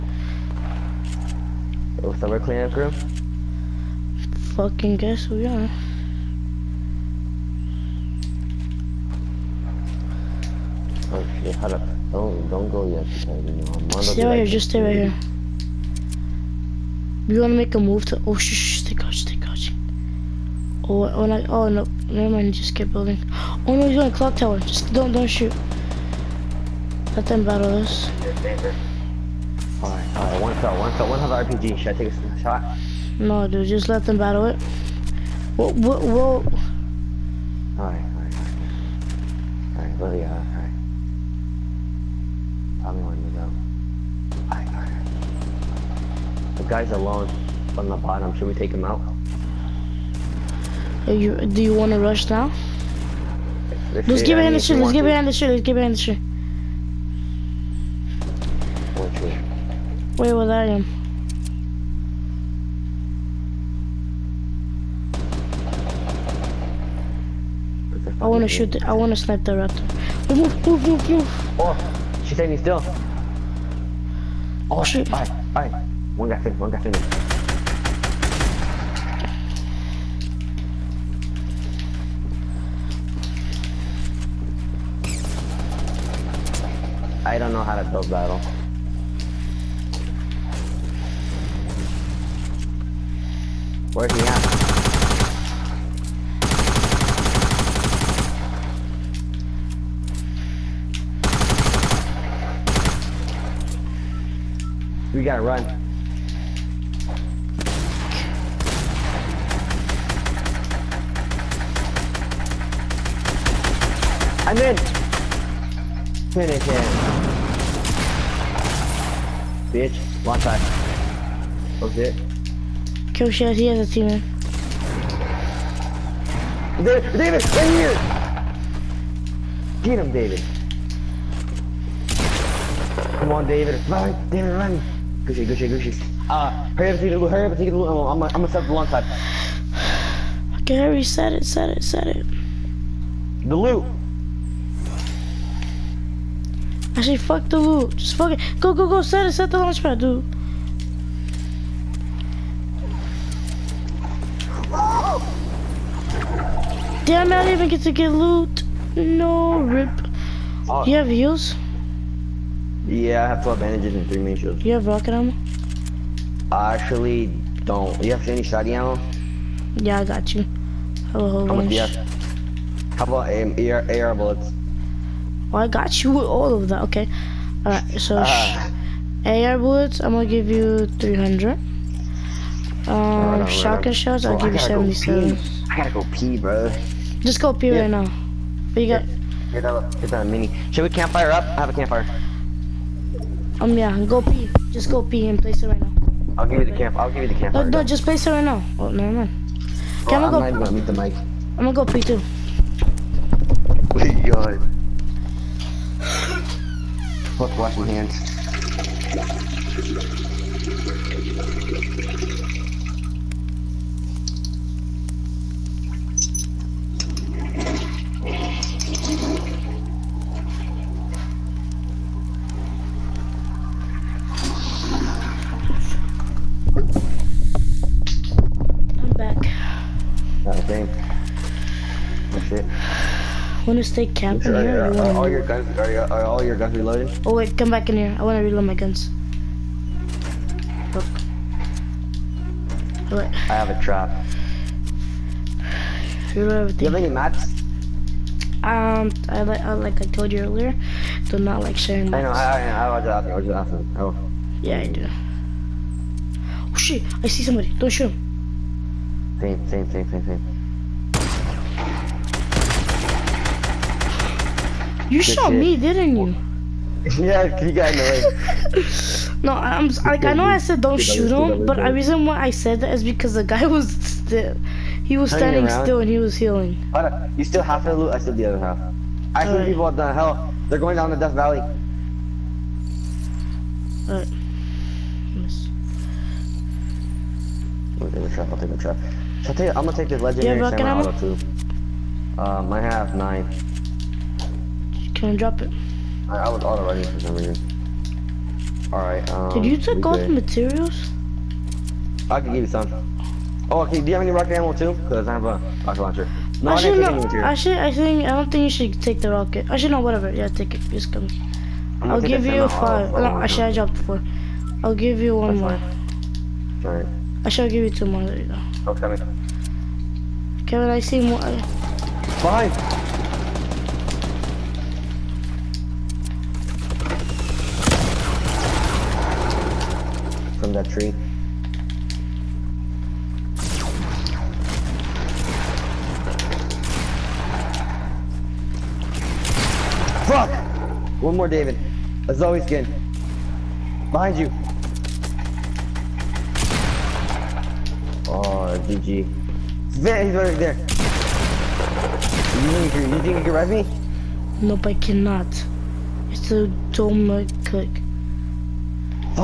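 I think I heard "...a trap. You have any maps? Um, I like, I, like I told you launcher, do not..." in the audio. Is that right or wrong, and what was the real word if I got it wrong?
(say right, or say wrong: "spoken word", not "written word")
wrong: "earlier", not "launcher".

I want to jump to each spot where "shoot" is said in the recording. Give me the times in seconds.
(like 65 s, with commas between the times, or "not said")
25 s, 68 s, 257 s, 270 s.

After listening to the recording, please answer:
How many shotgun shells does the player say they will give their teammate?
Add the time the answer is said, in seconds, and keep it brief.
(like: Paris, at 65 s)
77, at 184 s.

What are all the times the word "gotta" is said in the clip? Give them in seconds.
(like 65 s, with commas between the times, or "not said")
105 s, 185 s.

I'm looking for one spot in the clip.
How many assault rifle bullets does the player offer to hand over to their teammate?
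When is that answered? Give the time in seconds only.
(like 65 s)
180 s.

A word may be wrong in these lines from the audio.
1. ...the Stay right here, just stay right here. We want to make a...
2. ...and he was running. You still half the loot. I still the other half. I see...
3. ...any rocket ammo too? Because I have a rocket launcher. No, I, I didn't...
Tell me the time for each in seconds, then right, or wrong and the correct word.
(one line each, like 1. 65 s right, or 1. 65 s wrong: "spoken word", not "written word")
1. 13 s right
2. 275 s wrong: "healing", not "running"
3. 304 s right.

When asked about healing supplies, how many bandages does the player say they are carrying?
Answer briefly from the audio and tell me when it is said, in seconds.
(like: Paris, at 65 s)
12, at 163 s.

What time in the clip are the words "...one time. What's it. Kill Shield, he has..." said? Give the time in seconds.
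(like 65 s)
120 s.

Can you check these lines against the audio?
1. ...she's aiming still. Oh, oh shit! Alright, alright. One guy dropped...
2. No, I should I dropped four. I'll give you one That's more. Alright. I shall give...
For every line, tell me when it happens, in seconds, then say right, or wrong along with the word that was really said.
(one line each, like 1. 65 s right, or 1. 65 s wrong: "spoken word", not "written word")
1. 72 s wrong: "finished", not "dropped"
2. 313 s right.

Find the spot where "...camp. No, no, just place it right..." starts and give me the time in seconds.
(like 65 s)
197 s.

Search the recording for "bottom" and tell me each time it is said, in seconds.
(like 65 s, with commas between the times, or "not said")
47 s.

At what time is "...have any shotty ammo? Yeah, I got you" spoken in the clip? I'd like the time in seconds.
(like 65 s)
168 s.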